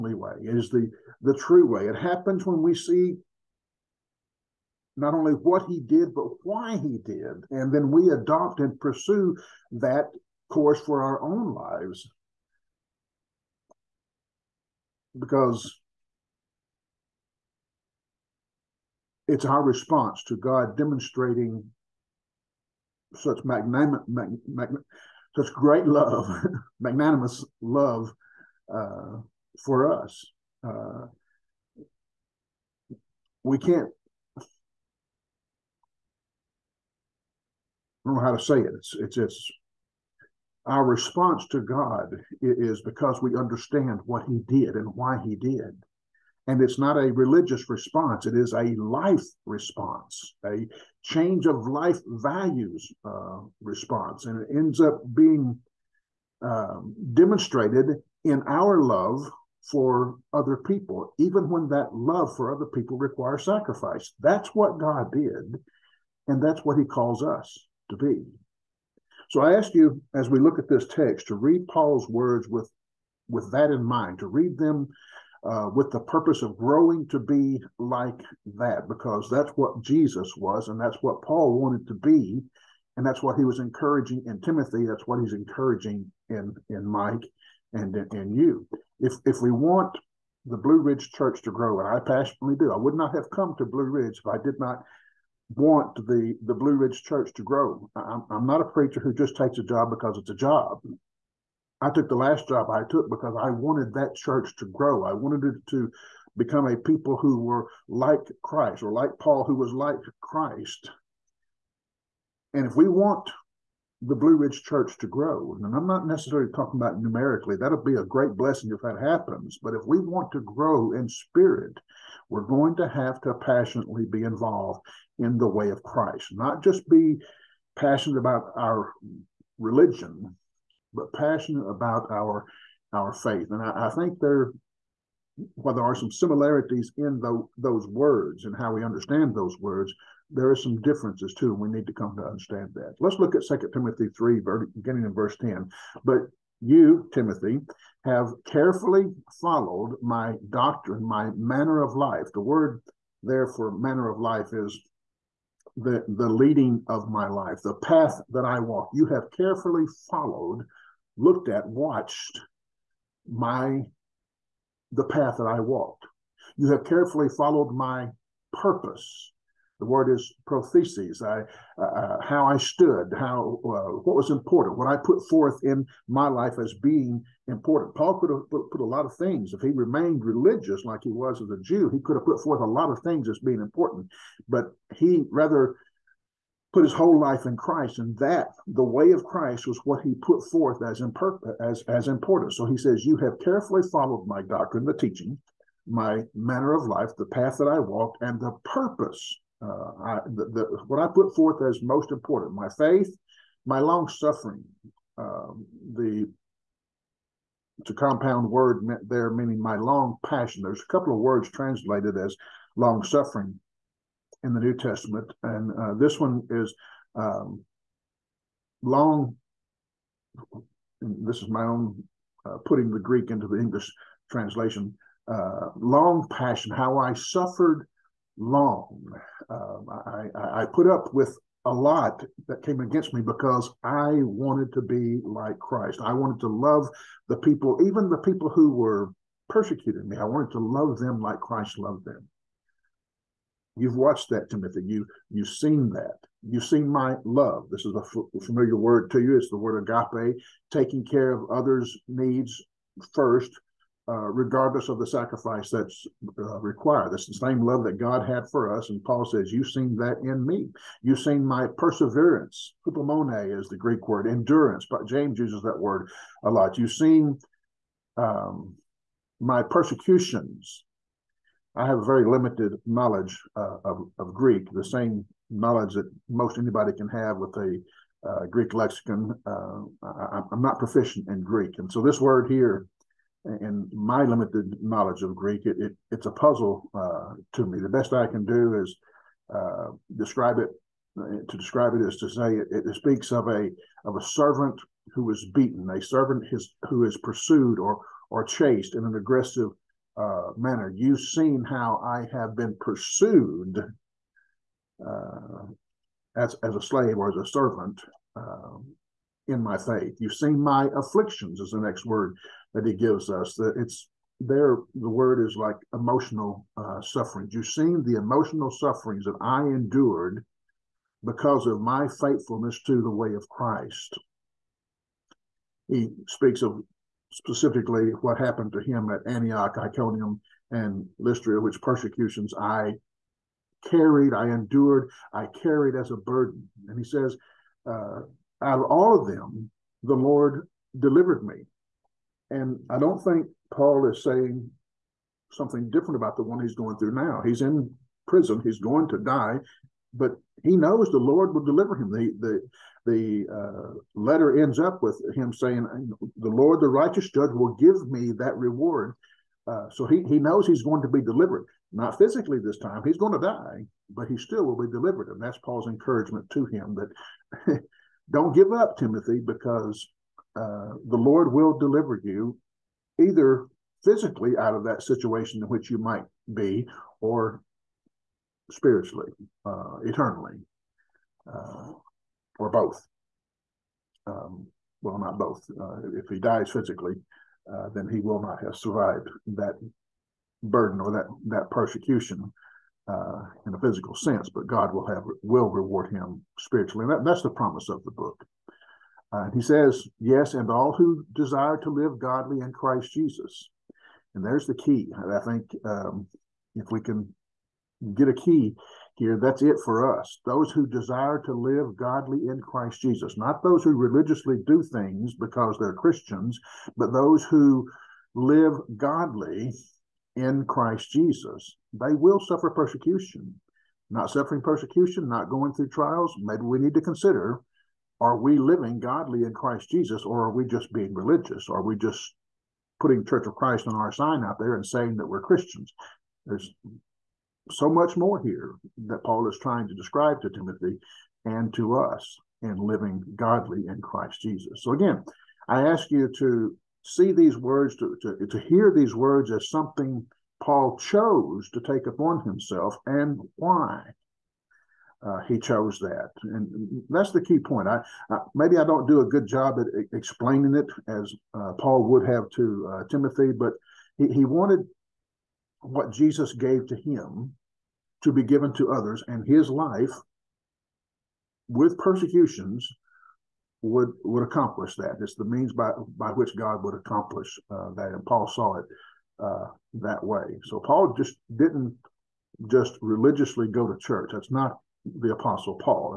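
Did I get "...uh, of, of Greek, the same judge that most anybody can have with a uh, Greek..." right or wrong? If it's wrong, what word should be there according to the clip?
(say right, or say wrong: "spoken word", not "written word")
wrong: "knowledge", not "judge".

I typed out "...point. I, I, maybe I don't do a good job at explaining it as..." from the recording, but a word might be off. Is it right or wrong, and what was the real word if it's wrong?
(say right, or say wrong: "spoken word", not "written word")
right.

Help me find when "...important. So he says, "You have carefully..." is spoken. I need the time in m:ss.
3:12.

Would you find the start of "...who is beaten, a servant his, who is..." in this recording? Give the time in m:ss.
4:55.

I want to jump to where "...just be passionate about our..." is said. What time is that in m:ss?
2:06.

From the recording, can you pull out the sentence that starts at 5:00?
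You've seen how I have been pursued uh, as as a slave or as a servant um, in my faith.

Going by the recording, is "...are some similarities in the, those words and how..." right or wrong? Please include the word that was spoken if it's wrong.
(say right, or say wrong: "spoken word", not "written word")
right.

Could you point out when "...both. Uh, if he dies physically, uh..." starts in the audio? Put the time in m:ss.
6:25.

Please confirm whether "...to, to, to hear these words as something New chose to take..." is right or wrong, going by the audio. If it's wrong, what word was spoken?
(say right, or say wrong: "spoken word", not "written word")
wrong: "Paul", not "New".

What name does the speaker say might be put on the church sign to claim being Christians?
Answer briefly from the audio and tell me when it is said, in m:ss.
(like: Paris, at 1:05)
Church of Christ, at 7:13.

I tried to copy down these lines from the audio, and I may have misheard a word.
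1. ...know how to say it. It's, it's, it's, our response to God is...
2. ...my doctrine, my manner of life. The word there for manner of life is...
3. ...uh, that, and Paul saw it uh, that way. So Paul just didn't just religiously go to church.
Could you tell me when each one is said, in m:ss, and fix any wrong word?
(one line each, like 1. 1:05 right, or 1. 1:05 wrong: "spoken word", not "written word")
1. 0:38 right
2. 2:30 right
3. 7:57 right.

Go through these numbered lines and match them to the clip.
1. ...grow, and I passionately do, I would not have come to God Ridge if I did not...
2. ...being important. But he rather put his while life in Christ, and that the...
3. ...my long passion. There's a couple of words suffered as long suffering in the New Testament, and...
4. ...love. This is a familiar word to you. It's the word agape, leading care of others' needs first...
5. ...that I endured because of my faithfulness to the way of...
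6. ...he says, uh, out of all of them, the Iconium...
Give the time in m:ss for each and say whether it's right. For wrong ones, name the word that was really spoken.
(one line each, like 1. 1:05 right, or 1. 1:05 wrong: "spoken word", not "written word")
1. 1:31 wrong: "Blue", not "God"
2. 3:03 wrong: "whole", not "while"
3. 3:29 wrong: "translated", not "suffered"
4. 4:07 wrong: "taking", not "leading"
5. 5:19 right
6. 5:36 wrong: "Lord", not "Iconium".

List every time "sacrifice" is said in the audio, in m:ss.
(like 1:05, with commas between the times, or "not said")
1:03, 4:15.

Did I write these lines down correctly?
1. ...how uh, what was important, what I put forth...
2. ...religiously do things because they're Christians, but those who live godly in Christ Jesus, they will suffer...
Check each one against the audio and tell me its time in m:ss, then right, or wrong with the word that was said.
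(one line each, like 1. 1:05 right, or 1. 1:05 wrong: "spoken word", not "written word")
1. 2:53 right
2. 6:53 right.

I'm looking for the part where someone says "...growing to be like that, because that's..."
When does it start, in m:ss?
1:16.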